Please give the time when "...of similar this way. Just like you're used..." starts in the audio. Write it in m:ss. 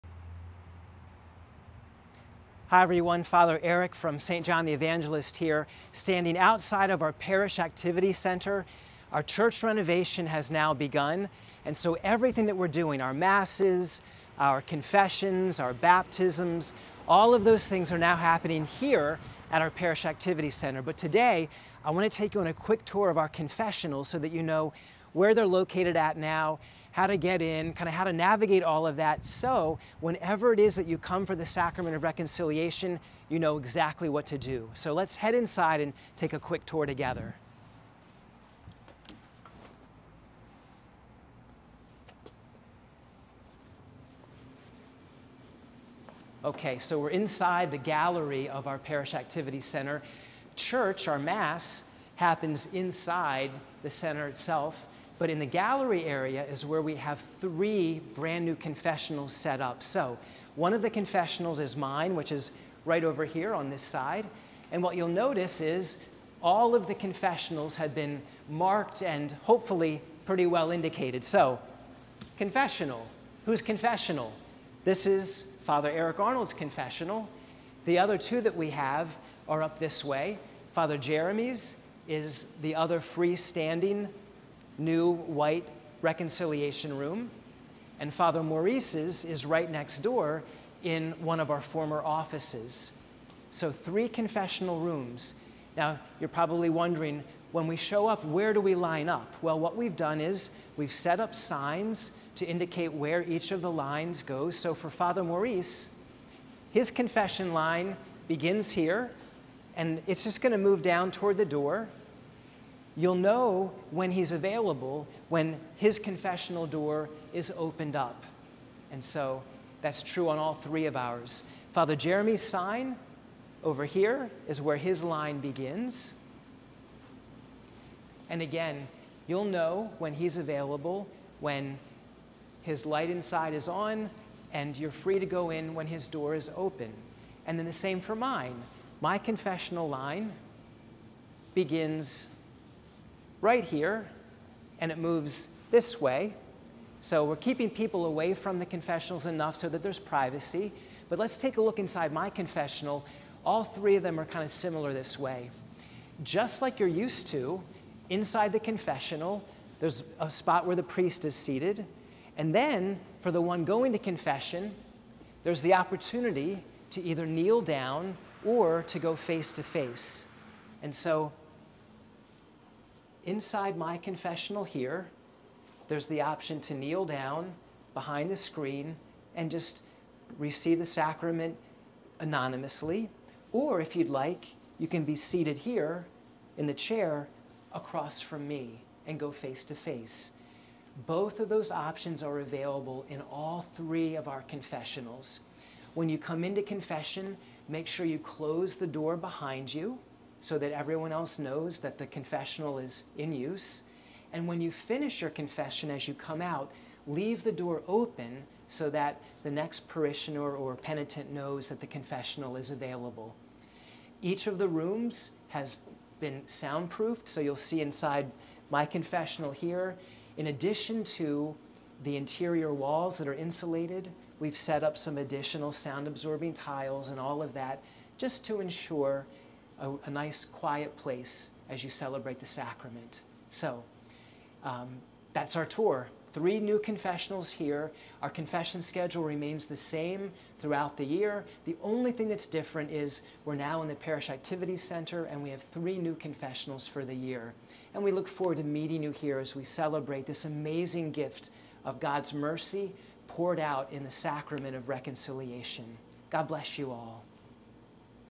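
2:34.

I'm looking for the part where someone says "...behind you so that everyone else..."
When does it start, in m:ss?
3:19.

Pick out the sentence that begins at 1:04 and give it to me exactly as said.
And what you'll notice is all of the confessionals have been marked and hopefully pretty well indicated.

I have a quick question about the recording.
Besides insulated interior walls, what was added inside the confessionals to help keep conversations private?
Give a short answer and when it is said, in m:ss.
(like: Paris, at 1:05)
Sound absorbing tiles, at 3:45.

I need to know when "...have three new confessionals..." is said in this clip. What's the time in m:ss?
4:05.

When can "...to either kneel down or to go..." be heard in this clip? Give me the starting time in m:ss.
2:46.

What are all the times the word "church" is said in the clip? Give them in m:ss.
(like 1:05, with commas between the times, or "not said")
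0:09, 0:50.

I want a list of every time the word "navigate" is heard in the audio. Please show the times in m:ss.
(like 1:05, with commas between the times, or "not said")
0:28.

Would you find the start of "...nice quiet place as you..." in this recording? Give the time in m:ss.
3:50.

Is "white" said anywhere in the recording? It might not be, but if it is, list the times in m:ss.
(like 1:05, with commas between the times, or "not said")
1:25.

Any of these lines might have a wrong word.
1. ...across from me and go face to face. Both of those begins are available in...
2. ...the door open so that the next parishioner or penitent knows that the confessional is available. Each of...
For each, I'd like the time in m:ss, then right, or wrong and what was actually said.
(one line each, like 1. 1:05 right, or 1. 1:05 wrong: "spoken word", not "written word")
1. 3:07 wrong: "options", not "begins"
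2. 3:27 right.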